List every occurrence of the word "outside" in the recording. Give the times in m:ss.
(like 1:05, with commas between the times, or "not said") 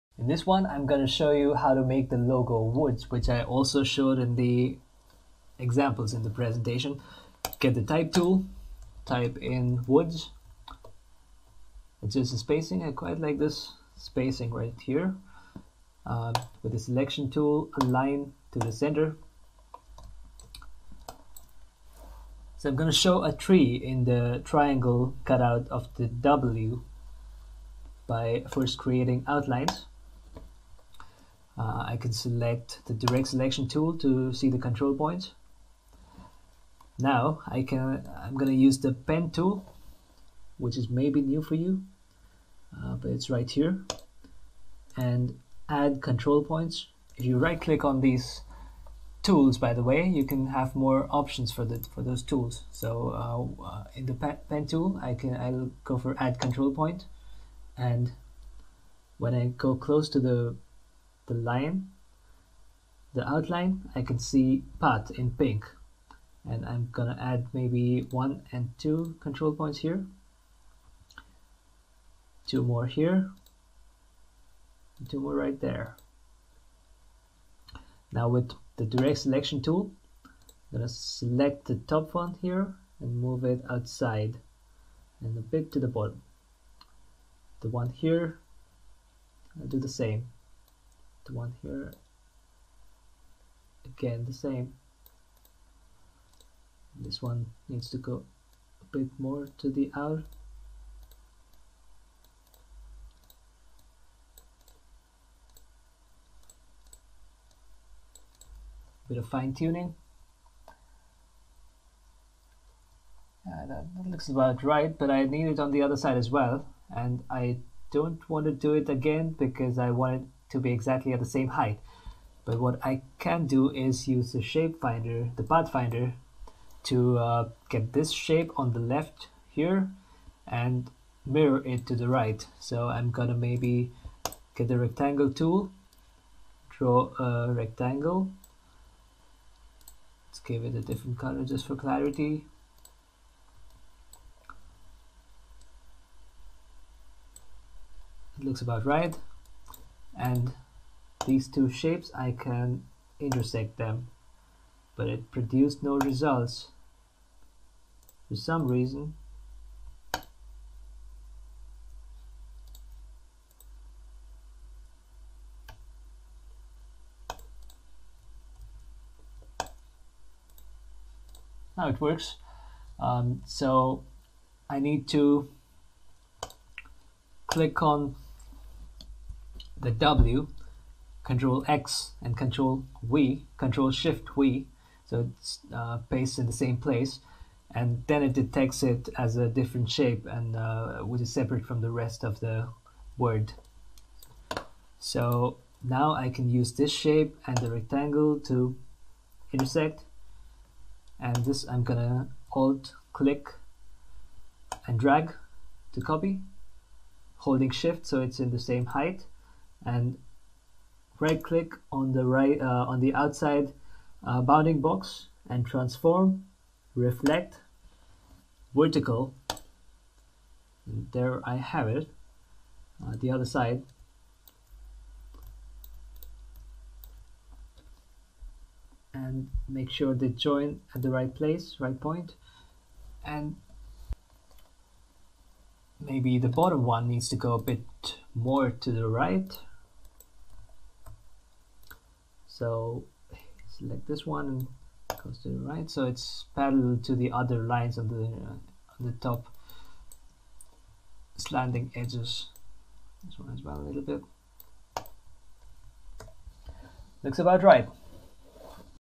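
1:23, 3:33.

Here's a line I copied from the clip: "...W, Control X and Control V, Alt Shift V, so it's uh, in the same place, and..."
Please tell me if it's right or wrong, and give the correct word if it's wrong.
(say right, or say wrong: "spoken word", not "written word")
wrong: "Control", not "Alt".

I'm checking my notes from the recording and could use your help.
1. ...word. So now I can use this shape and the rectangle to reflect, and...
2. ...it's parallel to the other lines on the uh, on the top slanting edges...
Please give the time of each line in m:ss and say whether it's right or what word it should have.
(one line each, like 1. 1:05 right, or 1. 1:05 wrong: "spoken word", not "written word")
1. 3:13 wrong: "intersect", not "reflect"
2. 4:06 right.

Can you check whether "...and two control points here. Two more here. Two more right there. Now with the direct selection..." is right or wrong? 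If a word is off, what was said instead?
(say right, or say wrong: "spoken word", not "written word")
right.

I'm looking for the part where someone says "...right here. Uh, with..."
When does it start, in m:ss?
0:14.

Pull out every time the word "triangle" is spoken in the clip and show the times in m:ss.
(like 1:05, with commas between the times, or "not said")
0:24.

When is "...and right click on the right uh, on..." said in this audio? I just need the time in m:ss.
3:29.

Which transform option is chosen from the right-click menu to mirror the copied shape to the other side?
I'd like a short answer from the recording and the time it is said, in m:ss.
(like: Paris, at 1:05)
reflect vertical, at 3:36.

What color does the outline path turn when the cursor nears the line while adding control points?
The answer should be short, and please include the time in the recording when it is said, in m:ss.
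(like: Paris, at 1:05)
pink, at 1:05.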